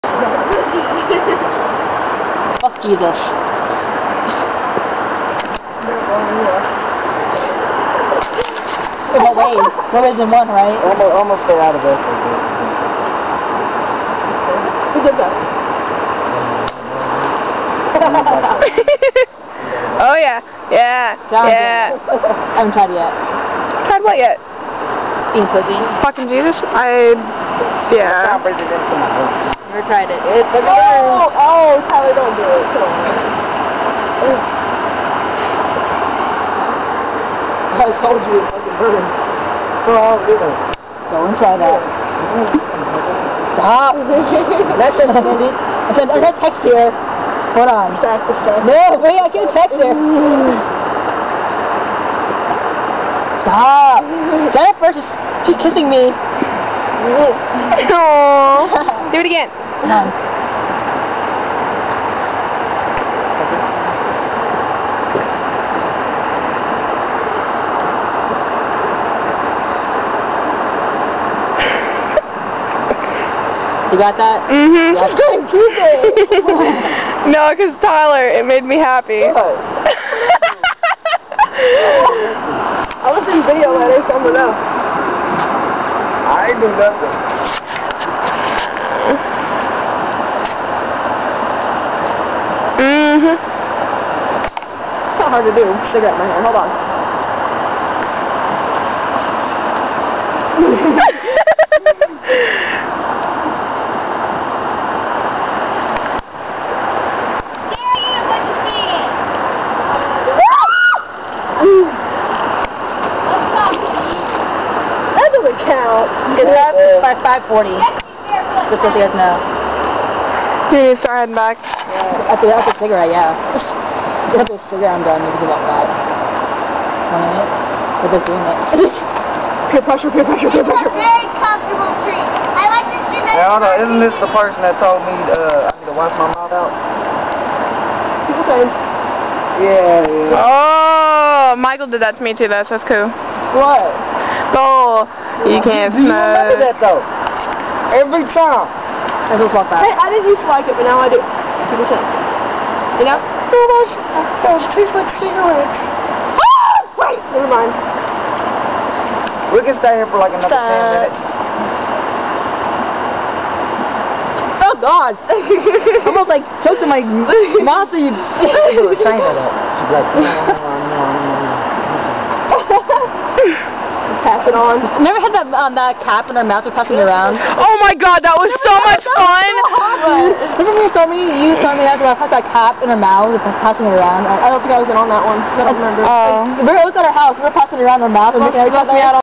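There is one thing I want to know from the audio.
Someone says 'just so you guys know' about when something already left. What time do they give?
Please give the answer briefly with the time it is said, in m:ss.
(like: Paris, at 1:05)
5:40, at 1:57.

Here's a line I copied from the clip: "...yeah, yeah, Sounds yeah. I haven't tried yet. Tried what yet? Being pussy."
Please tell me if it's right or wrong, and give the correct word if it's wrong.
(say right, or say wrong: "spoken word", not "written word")
right.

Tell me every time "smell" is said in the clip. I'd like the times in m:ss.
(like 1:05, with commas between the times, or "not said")
2:26.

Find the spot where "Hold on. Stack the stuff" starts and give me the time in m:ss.
0:47.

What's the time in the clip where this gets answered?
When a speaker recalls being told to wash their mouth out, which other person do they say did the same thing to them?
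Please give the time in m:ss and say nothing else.
2:21.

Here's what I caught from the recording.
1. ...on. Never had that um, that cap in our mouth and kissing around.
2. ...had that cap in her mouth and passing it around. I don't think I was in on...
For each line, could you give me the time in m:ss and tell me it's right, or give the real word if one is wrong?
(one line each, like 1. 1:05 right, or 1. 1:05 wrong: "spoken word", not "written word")
1. 2:54 wrong: "passing", not "kissing"
2. 3:02 right.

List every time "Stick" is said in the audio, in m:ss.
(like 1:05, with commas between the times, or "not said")
1:35.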